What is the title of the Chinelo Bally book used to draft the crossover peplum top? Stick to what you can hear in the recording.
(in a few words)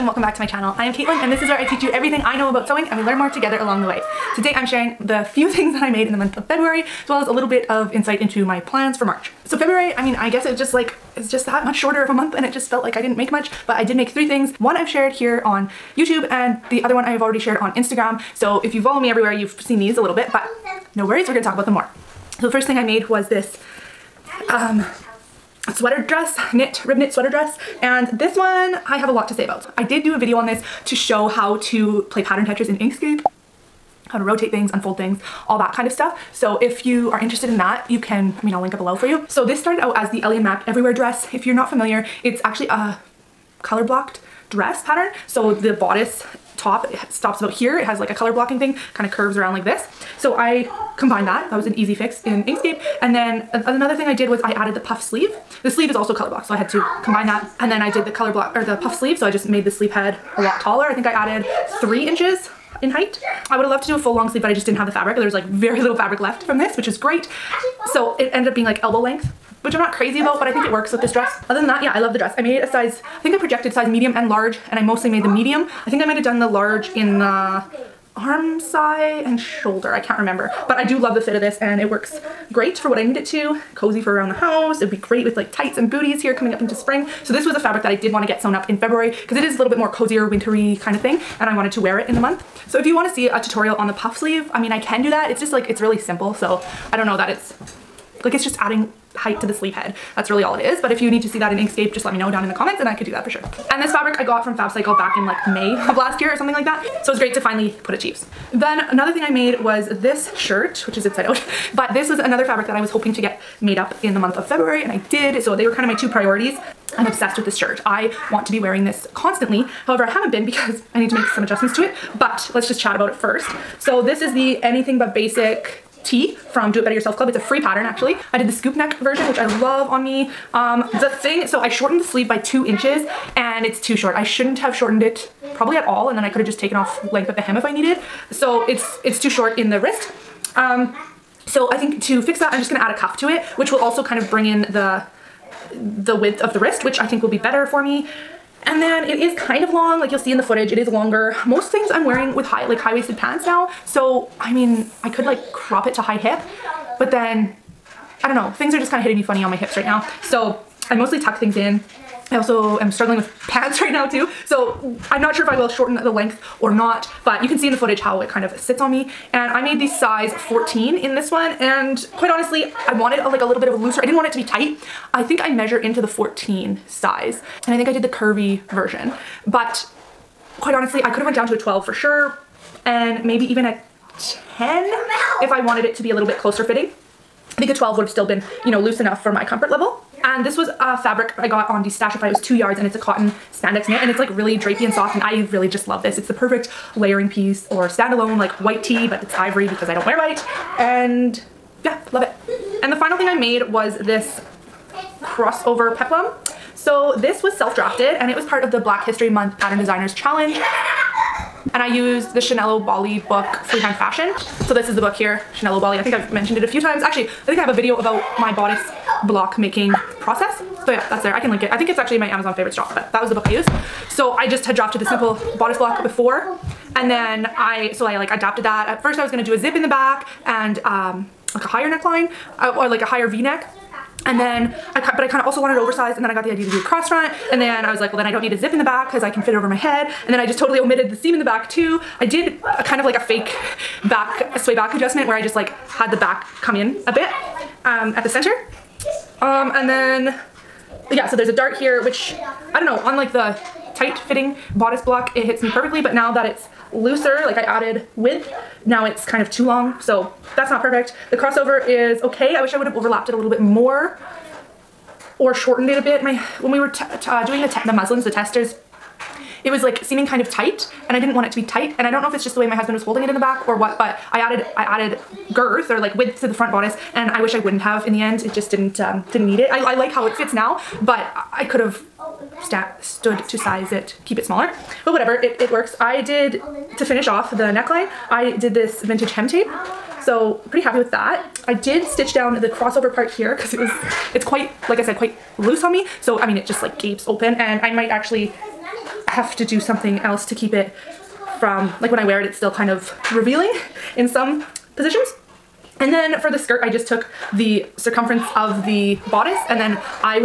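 Freehand Fashion.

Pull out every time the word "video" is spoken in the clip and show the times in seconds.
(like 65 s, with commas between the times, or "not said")
30 s, 217 s.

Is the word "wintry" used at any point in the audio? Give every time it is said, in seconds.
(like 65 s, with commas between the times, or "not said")
90 s.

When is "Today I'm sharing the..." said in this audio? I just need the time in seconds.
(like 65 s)
4 s.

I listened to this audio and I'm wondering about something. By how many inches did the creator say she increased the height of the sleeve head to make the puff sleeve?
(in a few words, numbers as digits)
3.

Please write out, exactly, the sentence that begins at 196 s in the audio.
It's the perfect layering piece or standalone like white tee but it's ivory because I don't wear white and yeah, love it.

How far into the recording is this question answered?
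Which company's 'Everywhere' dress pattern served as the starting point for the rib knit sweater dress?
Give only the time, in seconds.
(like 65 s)
40 s.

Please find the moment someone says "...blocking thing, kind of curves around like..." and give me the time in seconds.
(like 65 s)
48 s.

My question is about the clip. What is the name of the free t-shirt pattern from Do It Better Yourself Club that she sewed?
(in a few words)
Anything But Basic tee.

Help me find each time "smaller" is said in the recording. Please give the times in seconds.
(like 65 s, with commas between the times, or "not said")
284 s.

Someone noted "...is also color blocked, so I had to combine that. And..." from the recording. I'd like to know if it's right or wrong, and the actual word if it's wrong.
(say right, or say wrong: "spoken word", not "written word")
right.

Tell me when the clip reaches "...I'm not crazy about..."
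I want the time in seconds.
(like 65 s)
69 s.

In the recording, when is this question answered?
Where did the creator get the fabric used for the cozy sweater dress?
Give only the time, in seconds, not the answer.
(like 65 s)
104 s.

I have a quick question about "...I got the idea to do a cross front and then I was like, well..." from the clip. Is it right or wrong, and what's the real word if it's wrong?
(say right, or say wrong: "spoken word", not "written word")
right.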